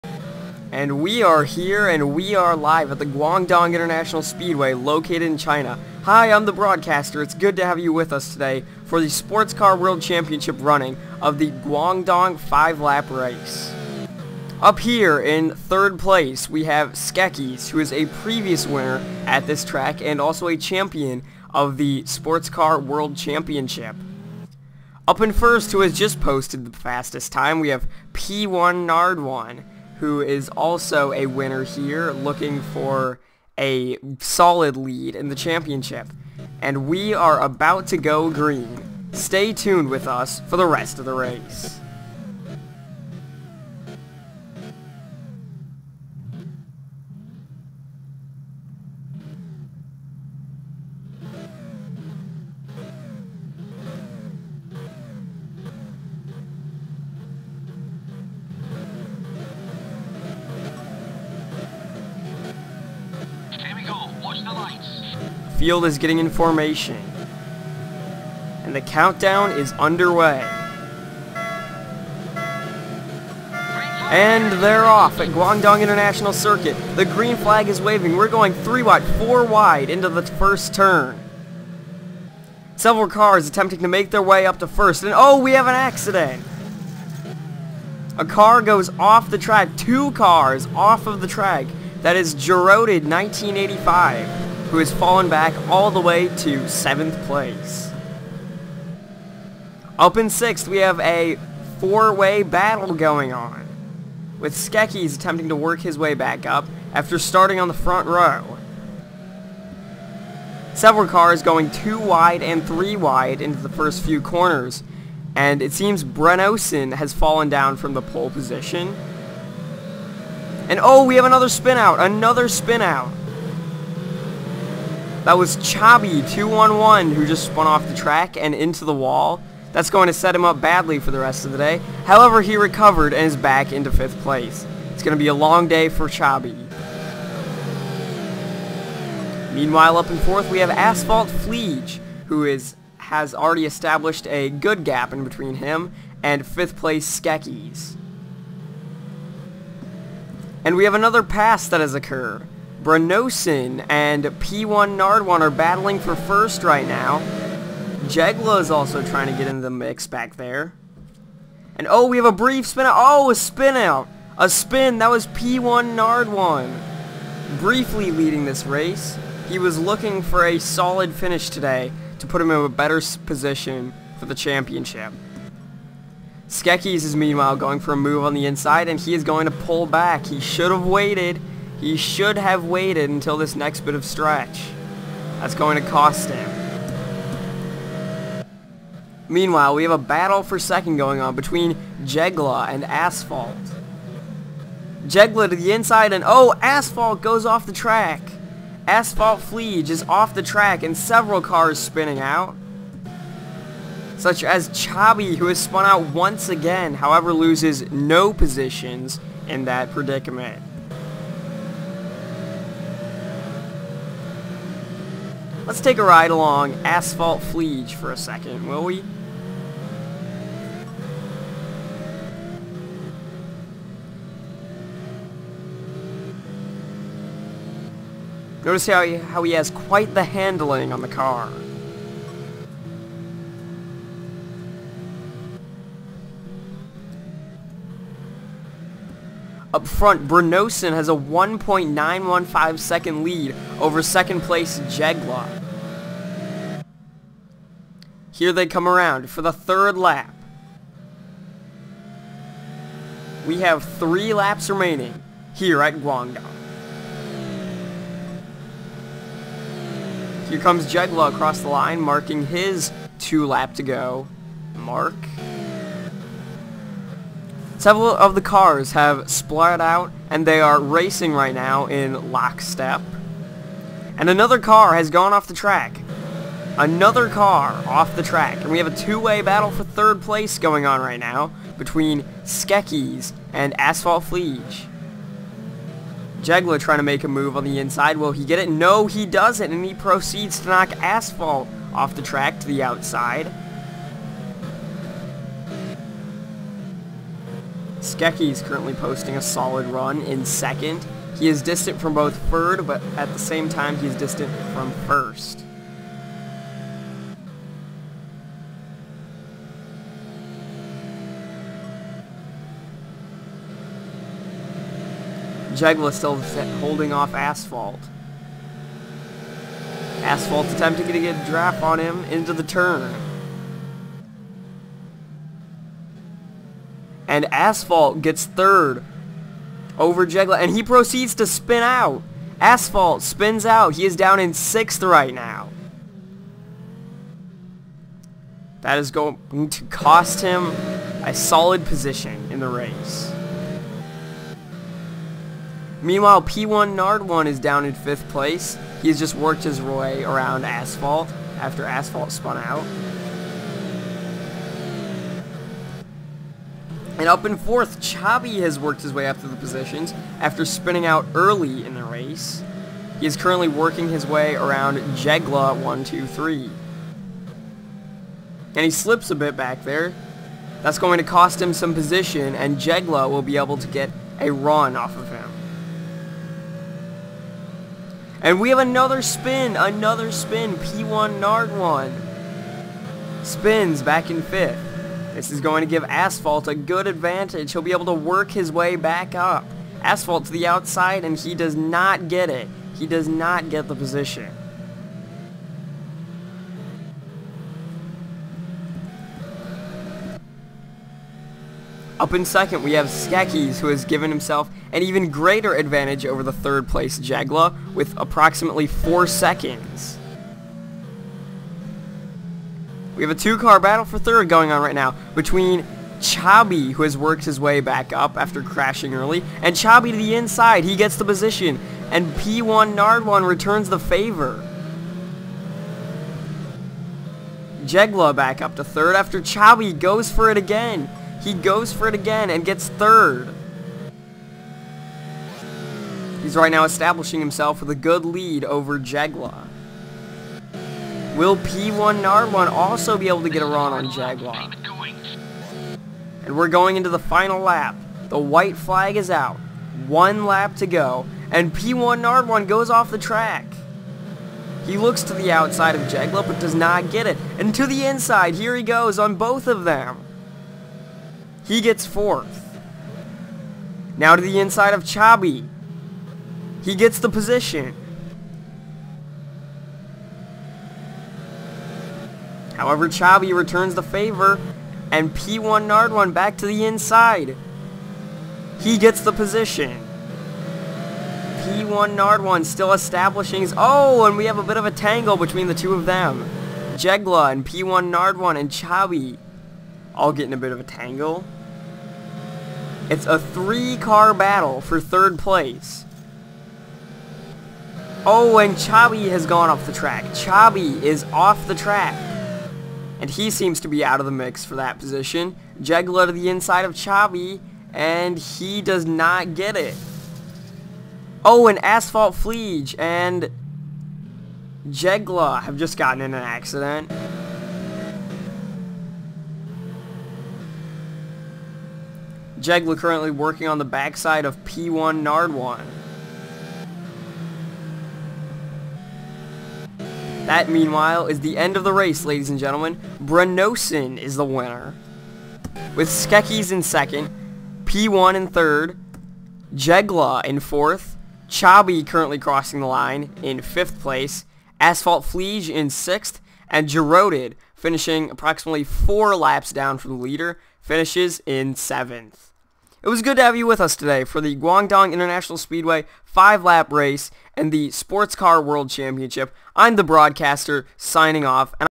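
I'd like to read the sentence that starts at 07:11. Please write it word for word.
He goes for it again and gets third.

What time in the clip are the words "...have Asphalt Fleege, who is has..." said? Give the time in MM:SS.
02:20.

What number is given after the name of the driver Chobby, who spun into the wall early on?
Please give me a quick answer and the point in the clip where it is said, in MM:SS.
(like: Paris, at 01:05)
211, at 02:05.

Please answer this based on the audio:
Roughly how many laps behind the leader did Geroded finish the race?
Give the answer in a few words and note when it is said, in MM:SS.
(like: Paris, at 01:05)
4 laps, at 09:08.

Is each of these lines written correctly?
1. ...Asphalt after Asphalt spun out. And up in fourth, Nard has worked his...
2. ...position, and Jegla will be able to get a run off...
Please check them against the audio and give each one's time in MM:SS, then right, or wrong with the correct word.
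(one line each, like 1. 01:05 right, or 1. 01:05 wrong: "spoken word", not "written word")
1. 05:50 wrong: "Chabi", not "Nard"
2. 06:11 right.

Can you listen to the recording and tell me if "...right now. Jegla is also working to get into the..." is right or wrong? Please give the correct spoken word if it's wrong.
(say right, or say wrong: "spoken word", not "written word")
wrong: "trying", not "working".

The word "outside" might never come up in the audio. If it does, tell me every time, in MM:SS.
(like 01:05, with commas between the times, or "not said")
04:52, 06:30, 07:35.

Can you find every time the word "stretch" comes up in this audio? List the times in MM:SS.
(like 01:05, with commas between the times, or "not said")
03:04.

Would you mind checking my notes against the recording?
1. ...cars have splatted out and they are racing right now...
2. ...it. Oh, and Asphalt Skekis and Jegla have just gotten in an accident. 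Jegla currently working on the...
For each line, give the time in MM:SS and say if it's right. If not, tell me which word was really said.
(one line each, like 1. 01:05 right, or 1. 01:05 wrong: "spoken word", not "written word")
1. 04:28 right
2. 08:29 wrong: "Fleege", not "Skekis".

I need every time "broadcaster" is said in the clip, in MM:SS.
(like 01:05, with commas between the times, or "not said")
00:06, 09:20.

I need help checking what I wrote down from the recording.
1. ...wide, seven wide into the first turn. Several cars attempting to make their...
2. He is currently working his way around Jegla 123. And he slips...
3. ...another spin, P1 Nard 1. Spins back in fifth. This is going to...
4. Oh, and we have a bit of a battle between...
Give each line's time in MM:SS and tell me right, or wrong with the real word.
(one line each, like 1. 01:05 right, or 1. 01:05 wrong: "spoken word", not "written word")
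1. 01:18 wrong: "four", not "seven"
2. 06:03 right
3. 06:19 right
4. 08:03 wrong: "tangle", not "battle".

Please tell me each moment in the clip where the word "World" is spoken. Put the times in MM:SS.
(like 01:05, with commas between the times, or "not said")
00:09, 00:22, 09:18.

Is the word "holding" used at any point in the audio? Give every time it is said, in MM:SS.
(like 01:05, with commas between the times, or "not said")
05:16.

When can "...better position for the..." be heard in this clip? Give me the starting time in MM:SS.
02:52.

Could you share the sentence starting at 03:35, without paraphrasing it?
Let's take a ride along Asphalt Fleege for a second, will we?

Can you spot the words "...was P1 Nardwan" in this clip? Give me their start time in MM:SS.
02:45.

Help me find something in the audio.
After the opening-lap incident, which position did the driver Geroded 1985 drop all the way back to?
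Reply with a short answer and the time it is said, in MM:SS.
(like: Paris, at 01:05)
7th place, at 01:36.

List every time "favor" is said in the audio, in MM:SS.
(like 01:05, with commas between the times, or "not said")
07:03, 07:54.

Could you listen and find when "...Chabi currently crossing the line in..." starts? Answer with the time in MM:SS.
09:01.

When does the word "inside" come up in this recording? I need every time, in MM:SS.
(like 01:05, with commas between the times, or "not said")
02:58, 03:15, 04:47, 07:00, 07:38, 07:44, 07:56, 08:26.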